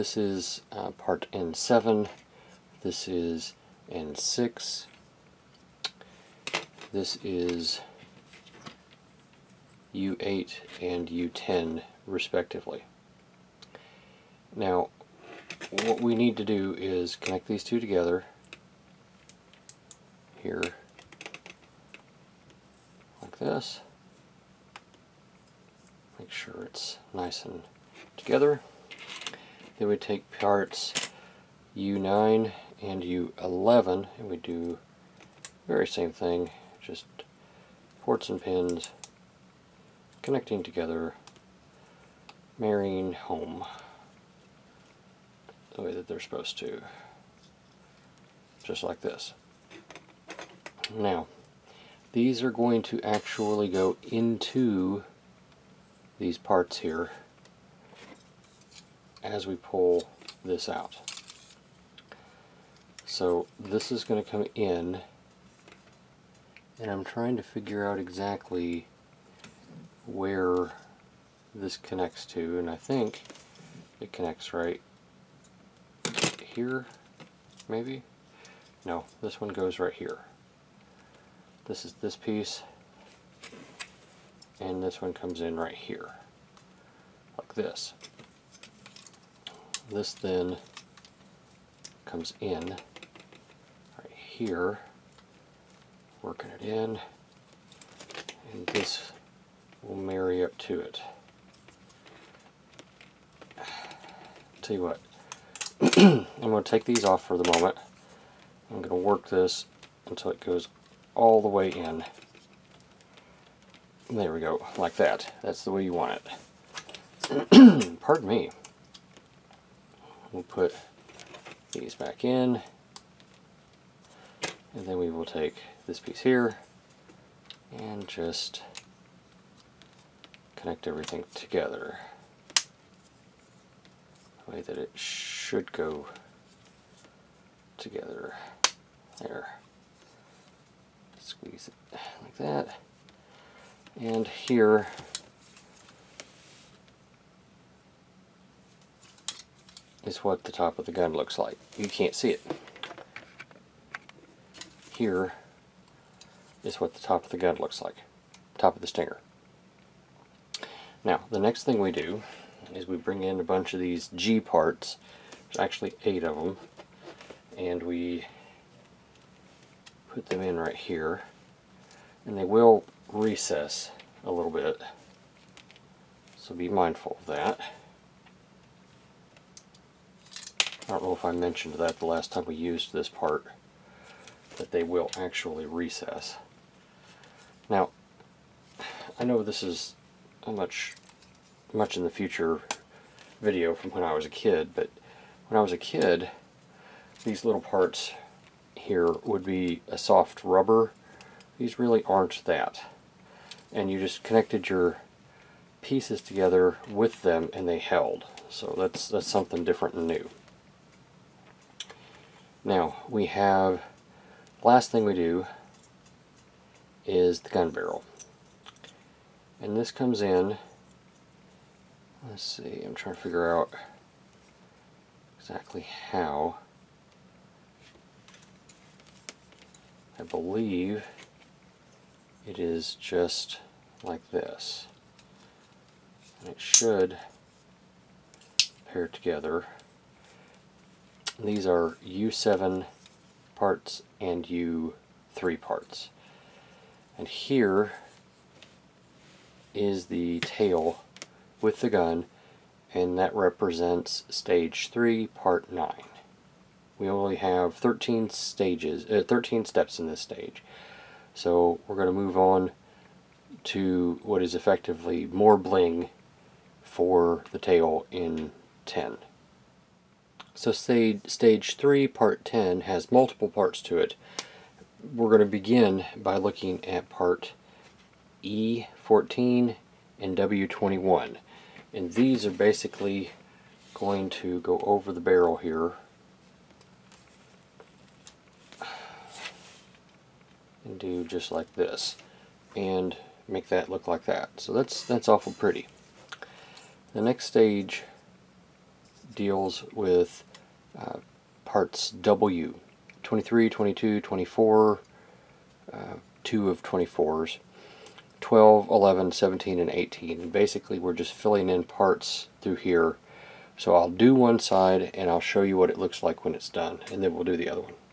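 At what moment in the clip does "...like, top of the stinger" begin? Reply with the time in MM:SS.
02:37.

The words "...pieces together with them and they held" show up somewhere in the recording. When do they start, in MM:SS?
03:25.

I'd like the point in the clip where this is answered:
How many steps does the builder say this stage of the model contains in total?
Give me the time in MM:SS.
04:19.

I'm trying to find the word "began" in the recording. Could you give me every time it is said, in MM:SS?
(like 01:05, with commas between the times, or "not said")
not said.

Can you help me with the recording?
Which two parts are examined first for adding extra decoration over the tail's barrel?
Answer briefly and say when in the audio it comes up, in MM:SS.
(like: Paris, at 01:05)
E14 and W21, at 04:38.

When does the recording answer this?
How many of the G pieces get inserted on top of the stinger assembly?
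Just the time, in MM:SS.
02:46.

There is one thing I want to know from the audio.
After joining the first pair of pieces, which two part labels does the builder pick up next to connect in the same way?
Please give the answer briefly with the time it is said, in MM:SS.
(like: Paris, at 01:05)
U9 and U11, at 00:31.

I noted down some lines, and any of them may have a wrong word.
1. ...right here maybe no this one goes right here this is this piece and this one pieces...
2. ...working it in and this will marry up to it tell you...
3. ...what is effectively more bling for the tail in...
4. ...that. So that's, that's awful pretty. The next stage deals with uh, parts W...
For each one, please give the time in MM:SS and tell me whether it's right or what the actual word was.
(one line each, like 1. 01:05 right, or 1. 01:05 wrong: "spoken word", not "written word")
1. 01:14 wrong: "comes", not "pieces"
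2. 01:36 right
3. 04:24 right
4. 04:54 right.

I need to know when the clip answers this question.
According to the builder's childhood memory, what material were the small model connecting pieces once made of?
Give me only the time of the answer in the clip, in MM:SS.
03:19.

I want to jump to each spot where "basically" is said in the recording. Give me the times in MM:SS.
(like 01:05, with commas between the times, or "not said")
04:42, 05:10.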